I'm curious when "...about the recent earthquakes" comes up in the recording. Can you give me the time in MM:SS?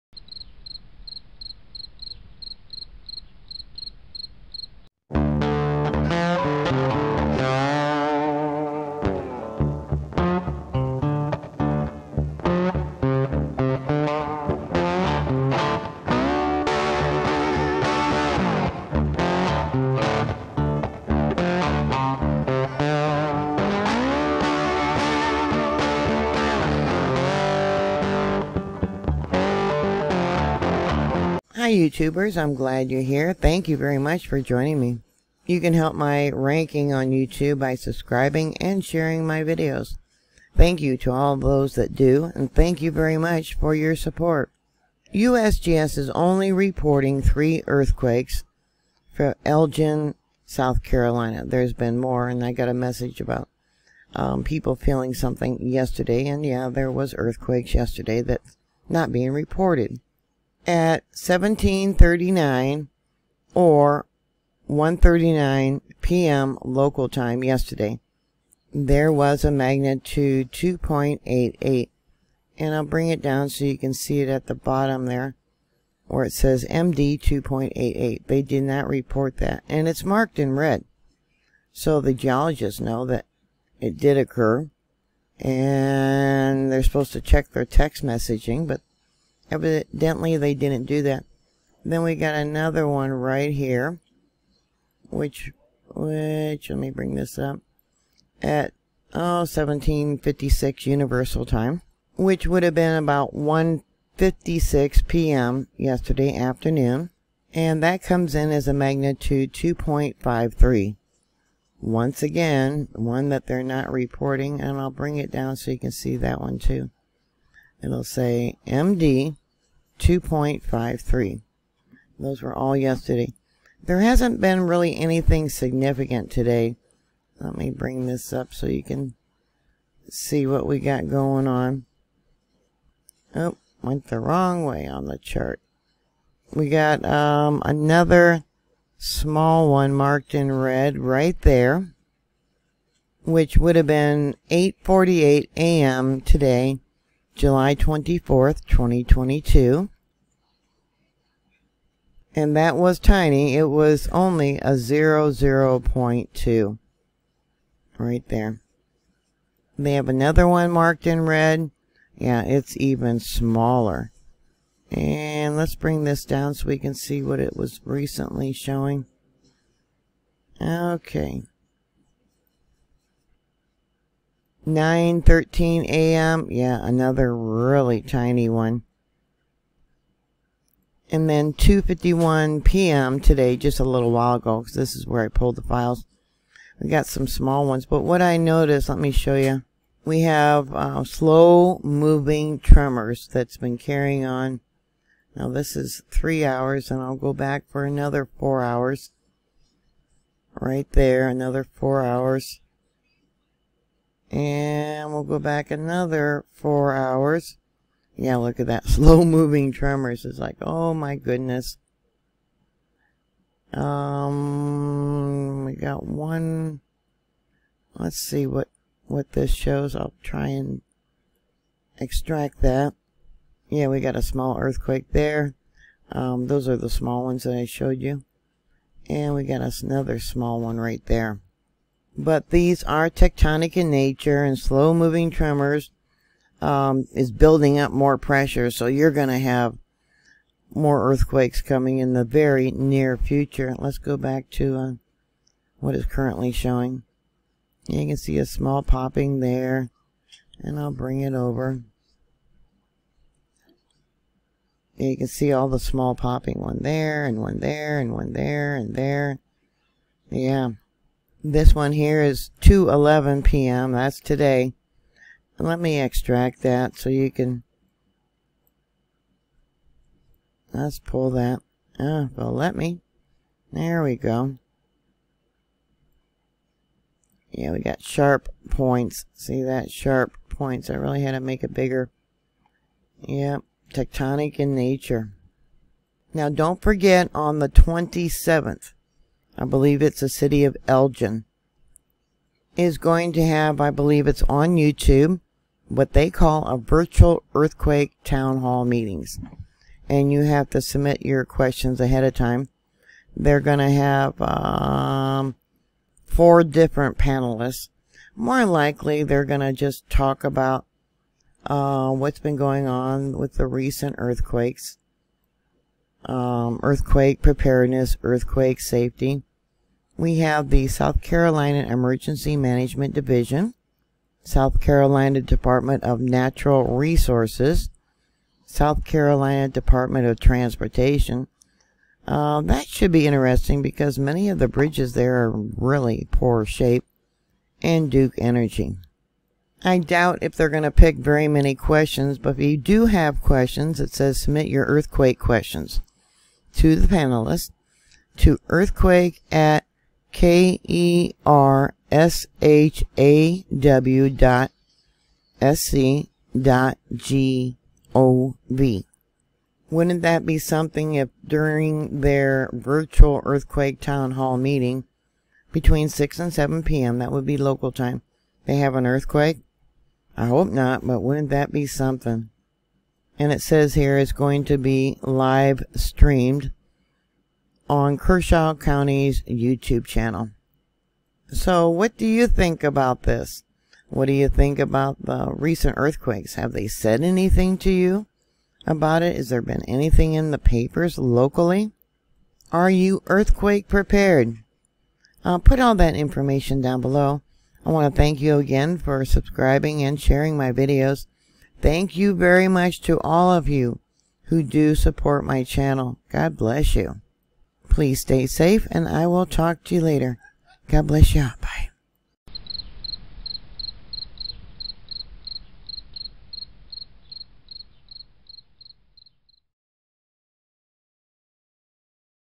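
06:24.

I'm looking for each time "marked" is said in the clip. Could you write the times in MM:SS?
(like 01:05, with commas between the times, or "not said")
01:20, 02:19, 02:40.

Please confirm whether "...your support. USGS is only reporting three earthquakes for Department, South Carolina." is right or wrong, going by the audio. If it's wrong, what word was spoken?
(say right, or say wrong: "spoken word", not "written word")
wrong: "Elgin", not "Department".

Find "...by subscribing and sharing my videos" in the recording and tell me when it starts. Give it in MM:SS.
00:37.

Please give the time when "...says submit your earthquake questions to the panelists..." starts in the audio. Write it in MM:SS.
05:44.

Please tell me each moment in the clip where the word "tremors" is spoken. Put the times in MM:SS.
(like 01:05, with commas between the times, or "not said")
03:12, 03:29, 03:55.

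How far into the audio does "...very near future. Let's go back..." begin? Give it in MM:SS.
04:02.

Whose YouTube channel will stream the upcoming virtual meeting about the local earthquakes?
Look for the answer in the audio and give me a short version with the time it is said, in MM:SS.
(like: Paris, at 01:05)
Kershaw County, at 06:18.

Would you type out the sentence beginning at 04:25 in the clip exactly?
Let me extract that so you can...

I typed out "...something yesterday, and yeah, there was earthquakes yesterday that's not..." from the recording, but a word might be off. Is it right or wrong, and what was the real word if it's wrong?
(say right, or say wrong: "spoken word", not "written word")
right.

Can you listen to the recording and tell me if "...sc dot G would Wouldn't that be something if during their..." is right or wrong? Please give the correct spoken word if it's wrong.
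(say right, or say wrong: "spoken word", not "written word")
right.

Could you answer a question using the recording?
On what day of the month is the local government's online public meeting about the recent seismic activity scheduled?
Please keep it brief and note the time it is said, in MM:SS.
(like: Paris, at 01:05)
27th, at 04:47.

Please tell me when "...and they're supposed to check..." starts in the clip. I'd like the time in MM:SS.
01:25.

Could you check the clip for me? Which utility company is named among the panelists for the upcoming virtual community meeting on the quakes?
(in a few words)
Duke Energy.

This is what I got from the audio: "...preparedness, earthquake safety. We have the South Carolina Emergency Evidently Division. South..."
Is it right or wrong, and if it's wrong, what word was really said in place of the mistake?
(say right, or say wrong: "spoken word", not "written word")
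wrong: "Management", not "Evidently".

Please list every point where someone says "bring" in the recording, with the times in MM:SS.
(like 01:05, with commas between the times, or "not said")
01:12, 01:36, 01:54, 02:07, 02:45, 04:10.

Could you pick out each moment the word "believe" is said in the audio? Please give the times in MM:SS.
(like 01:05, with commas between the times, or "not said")
04:49, 04:53.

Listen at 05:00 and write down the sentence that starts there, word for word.
And you have to submit your questions ahead of time.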